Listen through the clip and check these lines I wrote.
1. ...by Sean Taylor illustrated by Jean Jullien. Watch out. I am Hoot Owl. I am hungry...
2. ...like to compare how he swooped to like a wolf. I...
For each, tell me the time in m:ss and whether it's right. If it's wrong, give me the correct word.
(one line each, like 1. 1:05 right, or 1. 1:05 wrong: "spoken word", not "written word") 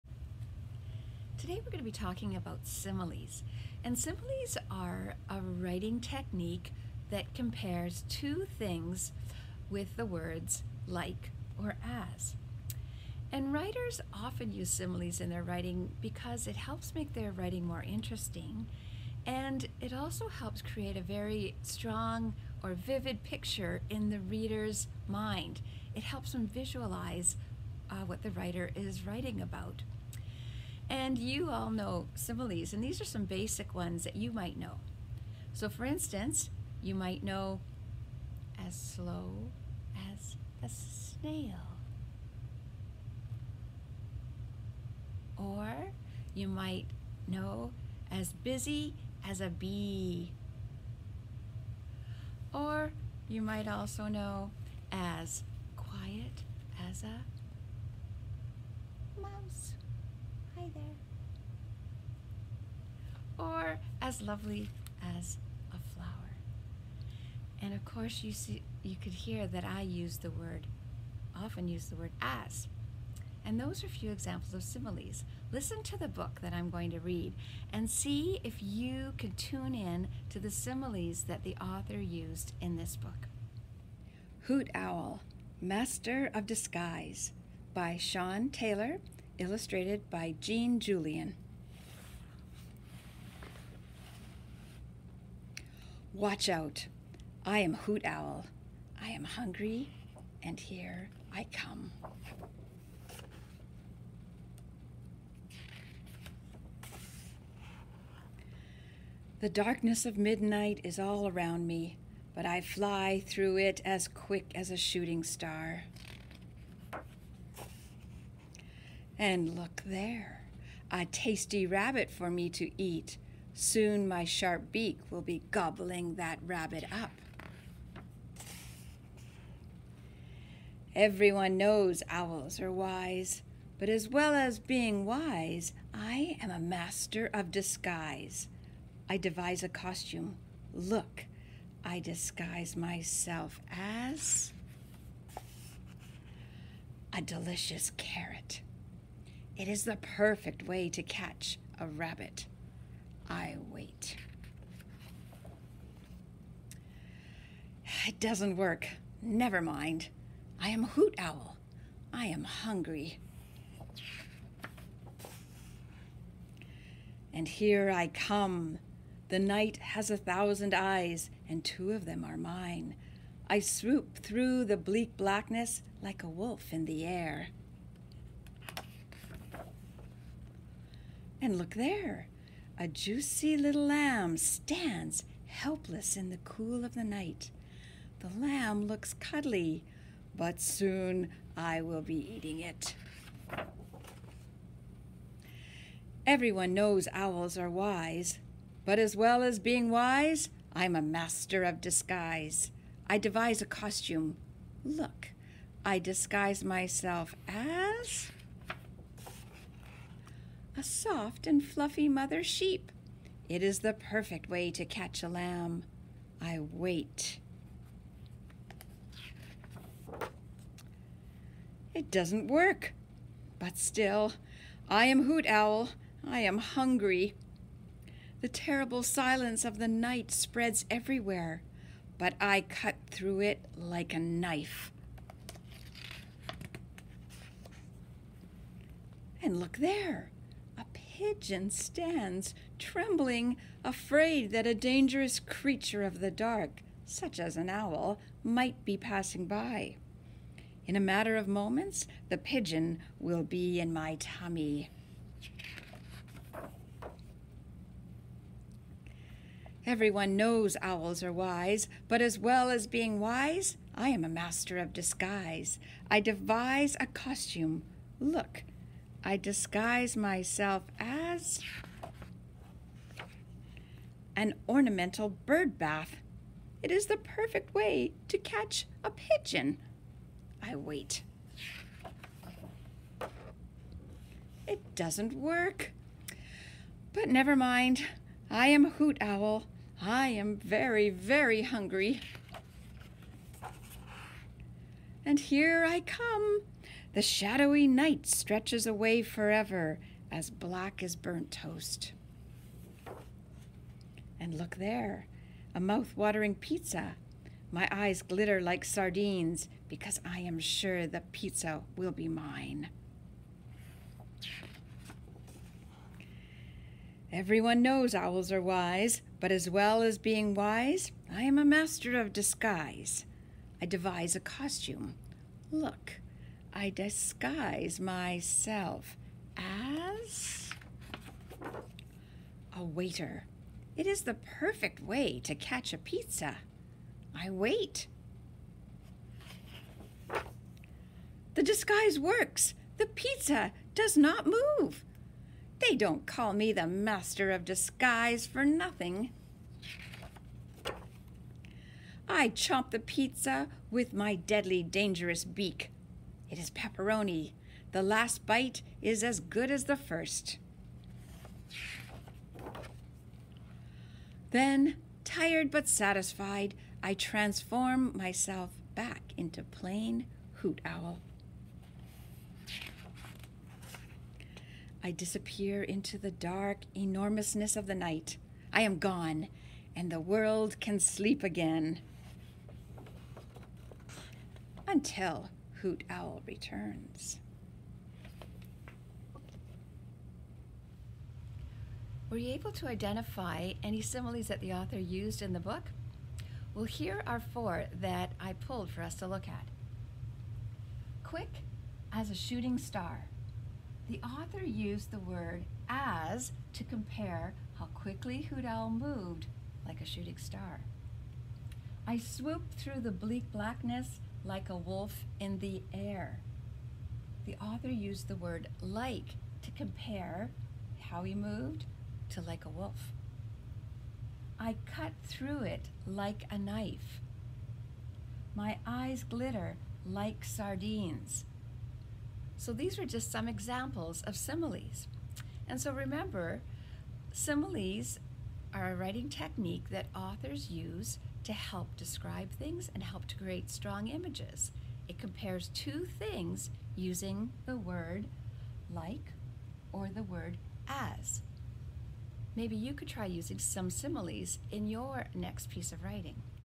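1. 1:27 right
2. 6:58 wrong: "moved", not "swooped".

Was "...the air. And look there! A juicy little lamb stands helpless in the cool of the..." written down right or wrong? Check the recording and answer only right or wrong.
right.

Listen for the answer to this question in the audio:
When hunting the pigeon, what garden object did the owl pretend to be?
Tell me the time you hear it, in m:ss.
4:34.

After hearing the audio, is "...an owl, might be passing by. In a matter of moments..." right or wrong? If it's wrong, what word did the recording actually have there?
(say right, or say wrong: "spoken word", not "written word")
right.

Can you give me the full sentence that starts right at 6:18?
I am gone, and the world can sleep again.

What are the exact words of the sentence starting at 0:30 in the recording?
And you all know some of these, and these are some basic ones that you might know.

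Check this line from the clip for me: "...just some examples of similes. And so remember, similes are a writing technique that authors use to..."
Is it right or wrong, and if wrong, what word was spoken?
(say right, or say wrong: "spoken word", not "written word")
right.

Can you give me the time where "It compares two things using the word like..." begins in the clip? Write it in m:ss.
7:25.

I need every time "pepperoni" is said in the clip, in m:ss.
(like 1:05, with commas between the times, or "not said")
5:56.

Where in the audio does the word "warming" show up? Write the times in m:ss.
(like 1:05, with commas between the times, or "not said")
not said.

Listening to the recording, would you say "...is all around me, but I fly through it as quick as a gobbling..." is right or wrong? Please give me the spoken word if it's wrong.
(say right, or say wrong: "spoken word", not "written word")
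wrong: "shooting", not "gobbling".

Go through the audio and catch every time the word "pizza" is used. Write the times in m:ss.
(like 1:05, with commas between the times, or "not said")
5:06, 5:11, 5:35, 5:43, 5:52.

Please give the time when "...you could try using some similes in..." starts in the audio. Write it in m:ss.
7:32.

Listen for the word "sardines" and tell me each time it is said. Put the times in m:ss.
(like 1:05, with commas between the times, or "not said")
5:08, 7:10.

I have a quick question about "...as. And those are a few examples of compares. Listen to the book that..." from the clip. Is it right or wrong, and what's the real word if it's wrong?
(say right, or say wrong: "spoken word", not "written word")
wrong: "similes", not "compares".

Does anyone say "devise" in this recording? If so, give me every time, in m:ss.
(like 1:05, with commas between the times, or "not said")
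2:19, 3:23, 4:26, 5:23.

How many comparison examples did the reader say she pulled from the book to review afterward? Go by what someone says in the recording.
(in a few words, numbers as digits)
4.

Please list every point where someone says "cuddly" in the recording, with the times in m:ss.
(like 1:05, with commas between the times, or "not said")
3:09.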